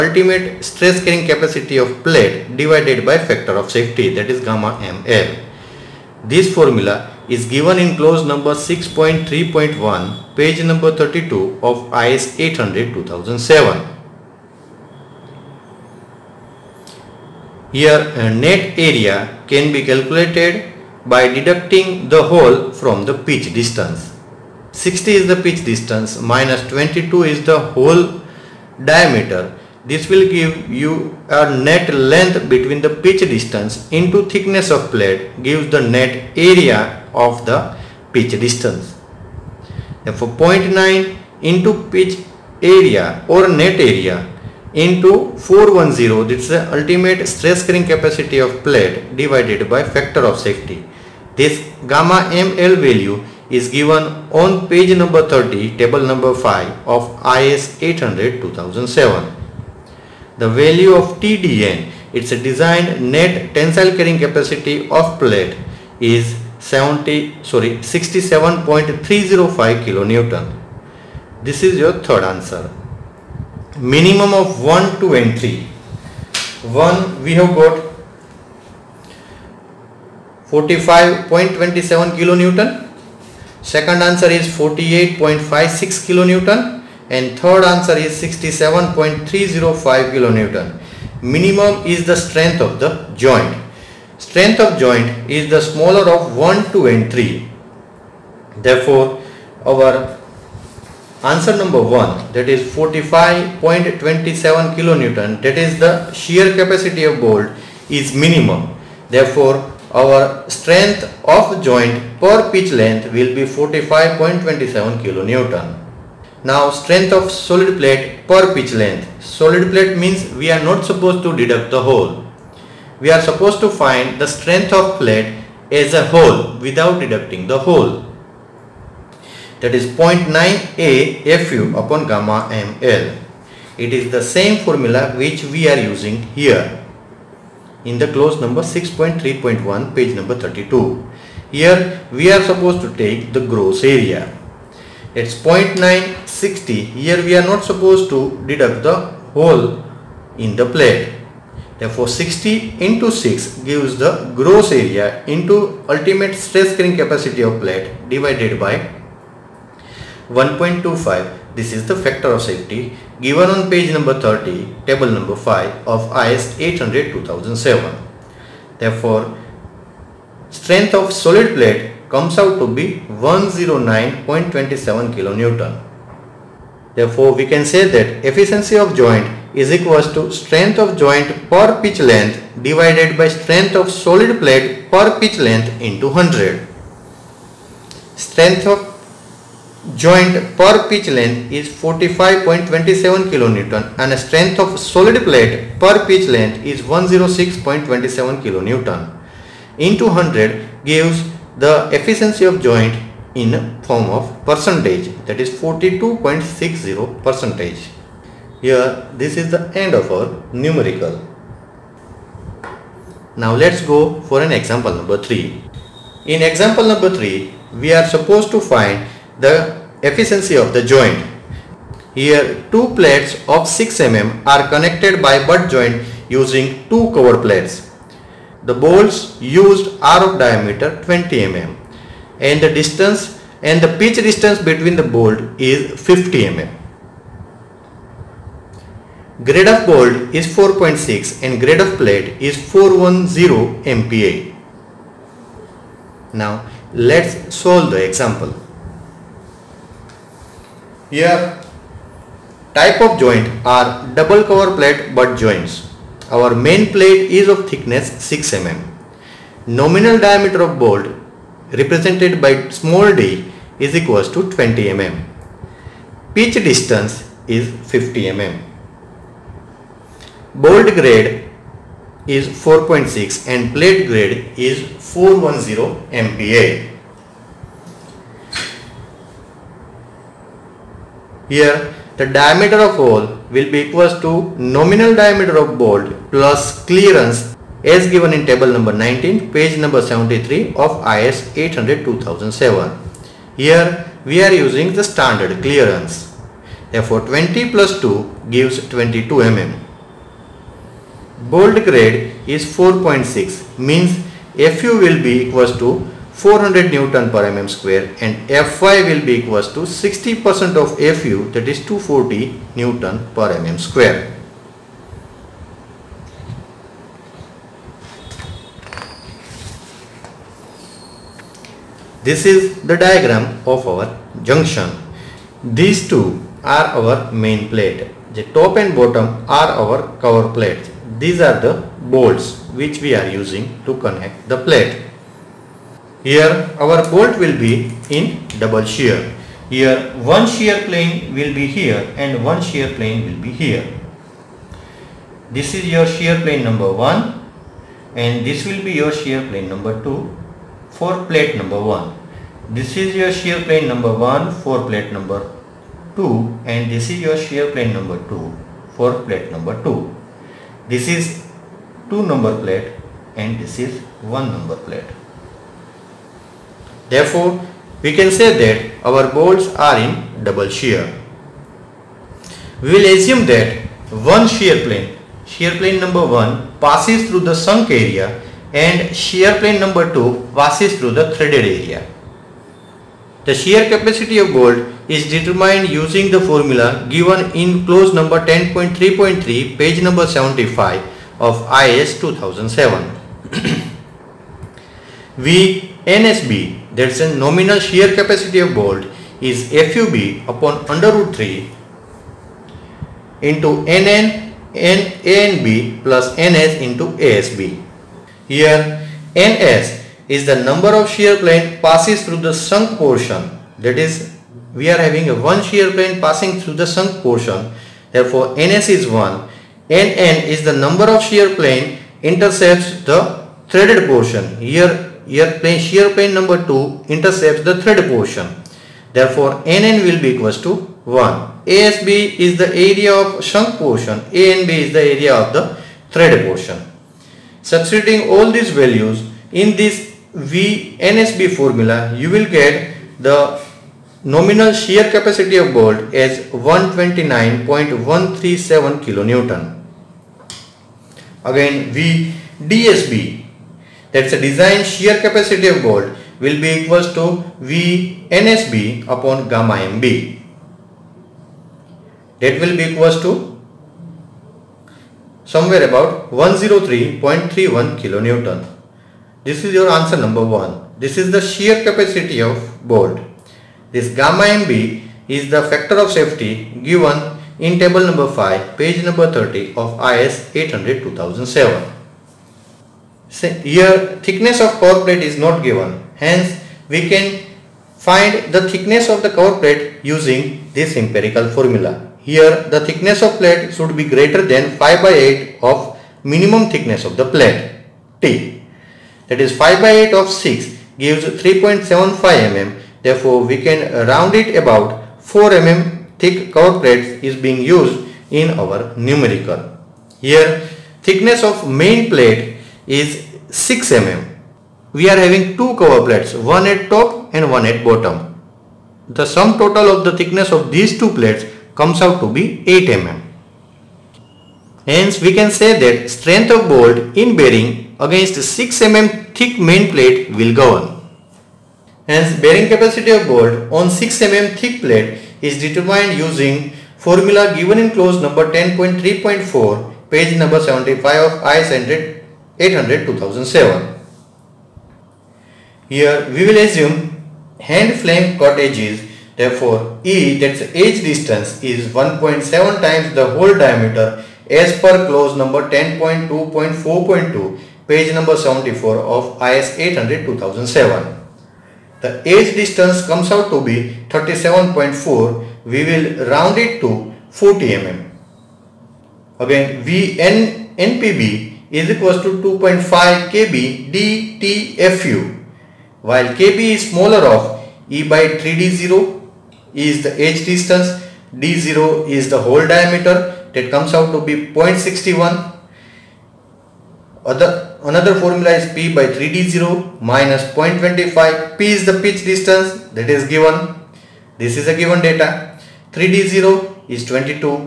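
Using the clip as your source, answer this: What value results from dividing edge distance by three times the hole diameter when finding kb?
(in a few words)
0.61.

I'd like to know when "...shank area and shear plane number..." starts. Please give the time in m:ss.
6:17.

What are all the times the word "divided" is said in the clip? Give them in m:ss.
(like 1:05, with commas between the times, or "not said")
0:02, 0:49, 2:38, 3:02.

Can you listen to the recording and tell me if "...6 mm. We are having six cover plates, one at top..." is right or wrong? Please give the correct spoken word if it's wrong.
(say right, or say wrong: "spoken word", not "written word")
wrong: "two", not "six".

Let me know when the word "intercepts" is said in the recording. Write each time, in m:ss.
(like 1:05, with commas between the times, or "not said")
7:02, 7:07.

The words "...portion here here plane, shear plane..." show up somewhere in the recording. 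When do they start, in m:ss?
7:04.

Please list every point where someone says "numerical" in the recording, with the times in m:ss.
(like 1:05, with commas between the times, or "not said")
3:30, 8:28.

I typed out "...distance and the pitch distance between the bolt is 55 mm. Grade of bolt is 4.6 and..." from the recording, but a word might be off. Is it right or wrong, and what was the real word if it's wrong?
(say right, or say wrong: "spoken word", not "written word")
wrong: "50", not "55".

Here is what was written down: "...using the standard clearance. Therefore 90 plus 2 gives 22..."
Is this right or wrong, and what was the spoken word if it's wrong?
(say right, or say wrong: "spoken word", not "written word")
wrong: "20", not "90".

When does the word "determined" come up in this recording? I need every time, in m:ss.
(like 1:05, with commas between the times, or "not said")
6:25, 8:55.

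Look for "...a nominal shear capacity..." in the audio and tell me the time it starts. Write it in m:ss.
6:37.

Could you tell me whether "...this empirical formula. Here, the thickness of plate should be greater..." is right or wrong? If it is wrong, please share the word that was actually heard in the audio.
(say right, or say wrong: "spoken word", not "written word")
right.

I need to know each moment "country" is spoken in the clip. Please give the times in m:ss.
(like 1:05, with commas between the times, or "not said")
not said.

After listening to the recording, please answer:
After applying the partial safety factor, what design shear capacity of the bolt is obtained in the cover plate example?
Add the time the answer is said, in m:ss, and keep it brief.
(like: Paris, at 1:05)
103.31 kN, at 7:46.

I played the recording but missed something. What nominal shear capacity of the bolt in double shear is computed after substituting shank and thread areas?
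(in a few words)
129.137 kN.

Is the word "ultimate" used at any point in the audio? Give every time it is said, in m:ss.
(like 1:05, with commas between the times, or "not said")
0:46, 2:35.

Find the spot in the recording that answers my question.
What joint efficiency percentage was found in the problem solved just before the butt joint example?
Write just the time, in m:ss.
3:25.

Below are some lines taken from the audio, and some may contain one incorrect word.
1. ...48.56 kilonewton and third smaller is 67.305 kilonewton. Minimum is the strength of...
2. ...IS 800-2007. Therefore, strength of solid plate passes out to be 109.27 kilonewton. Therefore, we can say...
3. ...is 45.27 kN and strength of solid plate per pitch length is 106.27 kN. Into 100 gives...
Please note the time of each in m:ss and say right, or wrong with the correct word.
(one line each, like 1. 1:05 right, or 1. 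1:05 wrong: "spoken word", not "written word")
1. 1:24 wrong: "answer", not "smaller"
2. 2:46 wrong: "comes", not "passes"
3. 3:11 right.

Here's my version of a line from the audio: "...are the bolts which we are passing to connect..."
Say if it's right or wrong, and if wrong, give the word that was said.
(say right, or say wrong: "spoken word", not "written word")
wrong: "using", not "passing".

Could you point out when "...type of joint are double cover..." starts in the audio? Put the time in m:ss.
4:12.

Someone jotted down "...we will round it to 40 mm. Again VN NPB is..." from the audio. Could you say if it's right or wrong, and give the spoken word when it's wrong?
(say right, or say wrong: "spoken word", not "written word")
right.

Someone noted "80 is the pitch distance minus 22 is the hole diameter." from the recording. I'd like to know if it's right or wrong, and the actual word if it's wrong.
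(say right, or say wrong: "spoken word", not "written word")
wrong: "60", not "80".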